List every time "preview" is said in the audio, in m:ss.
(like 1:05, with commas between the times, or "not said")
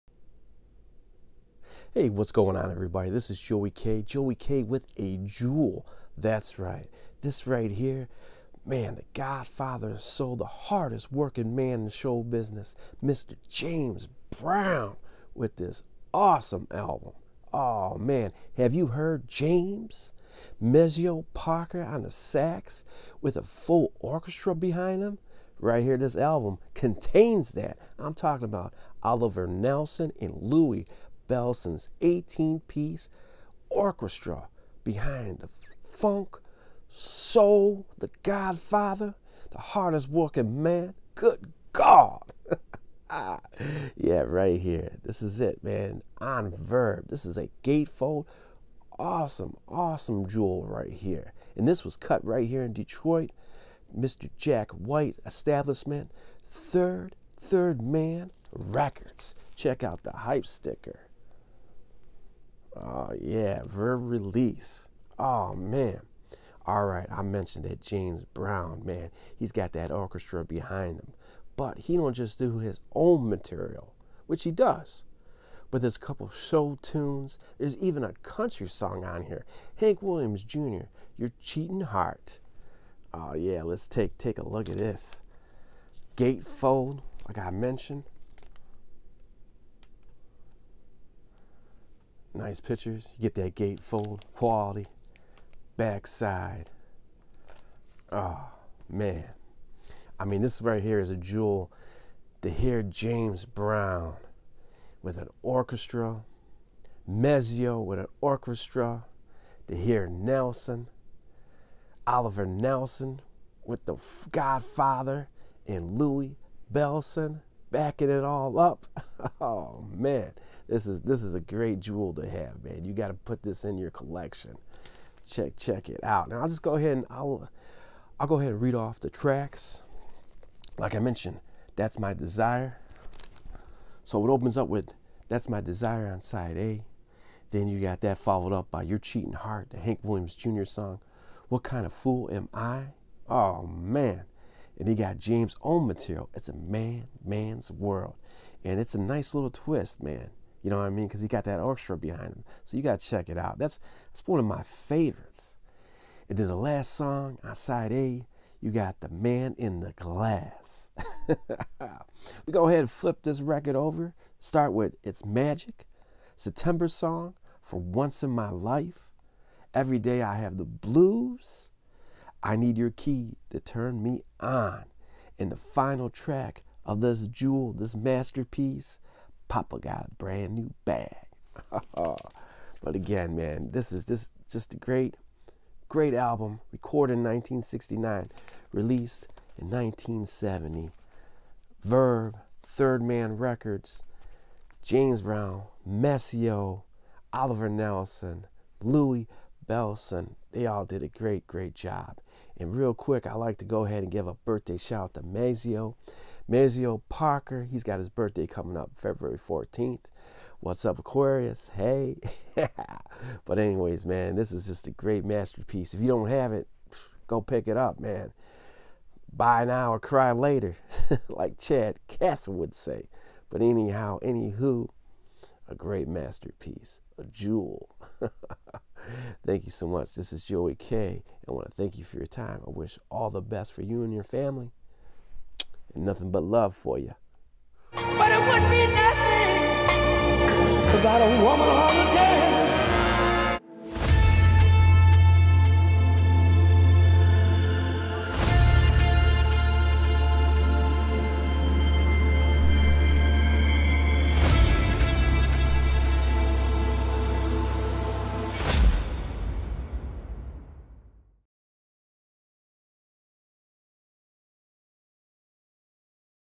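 not said.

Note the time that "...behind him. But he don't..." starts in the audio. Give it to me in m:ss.
1:10.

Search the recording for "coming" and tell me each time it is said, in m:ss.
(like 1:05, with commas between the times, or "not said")
3:28.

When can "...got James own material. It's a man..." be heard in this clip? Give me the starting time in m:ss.
2:24.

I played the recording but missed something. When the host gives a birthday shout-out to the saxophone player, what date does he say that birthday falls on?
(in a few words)
February 14.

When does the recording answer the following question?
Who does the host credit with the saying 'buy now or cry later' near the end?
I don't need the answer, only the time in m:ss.
3:41.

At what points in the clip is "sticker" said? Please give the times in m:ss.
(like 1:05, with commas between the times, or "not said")
1:00.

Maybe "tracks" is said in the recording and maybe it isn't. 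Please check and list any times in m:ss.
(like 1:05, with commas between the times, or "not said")
2:09, 2:56.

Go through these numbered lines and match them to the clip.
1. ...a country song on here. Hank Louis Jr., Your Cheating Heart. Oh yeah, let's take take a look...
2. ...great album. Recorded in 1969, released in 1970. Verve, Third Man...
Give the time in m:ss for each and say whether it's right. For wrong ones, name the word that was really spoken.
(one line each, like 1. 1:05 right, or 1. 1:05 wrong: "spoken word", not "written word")
1. 1:18 wrong: "Williams", not "Louis"
2. 3:05 right.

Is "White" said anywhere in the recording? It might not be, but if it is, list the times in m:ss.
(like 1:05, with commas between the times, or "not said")
0:54.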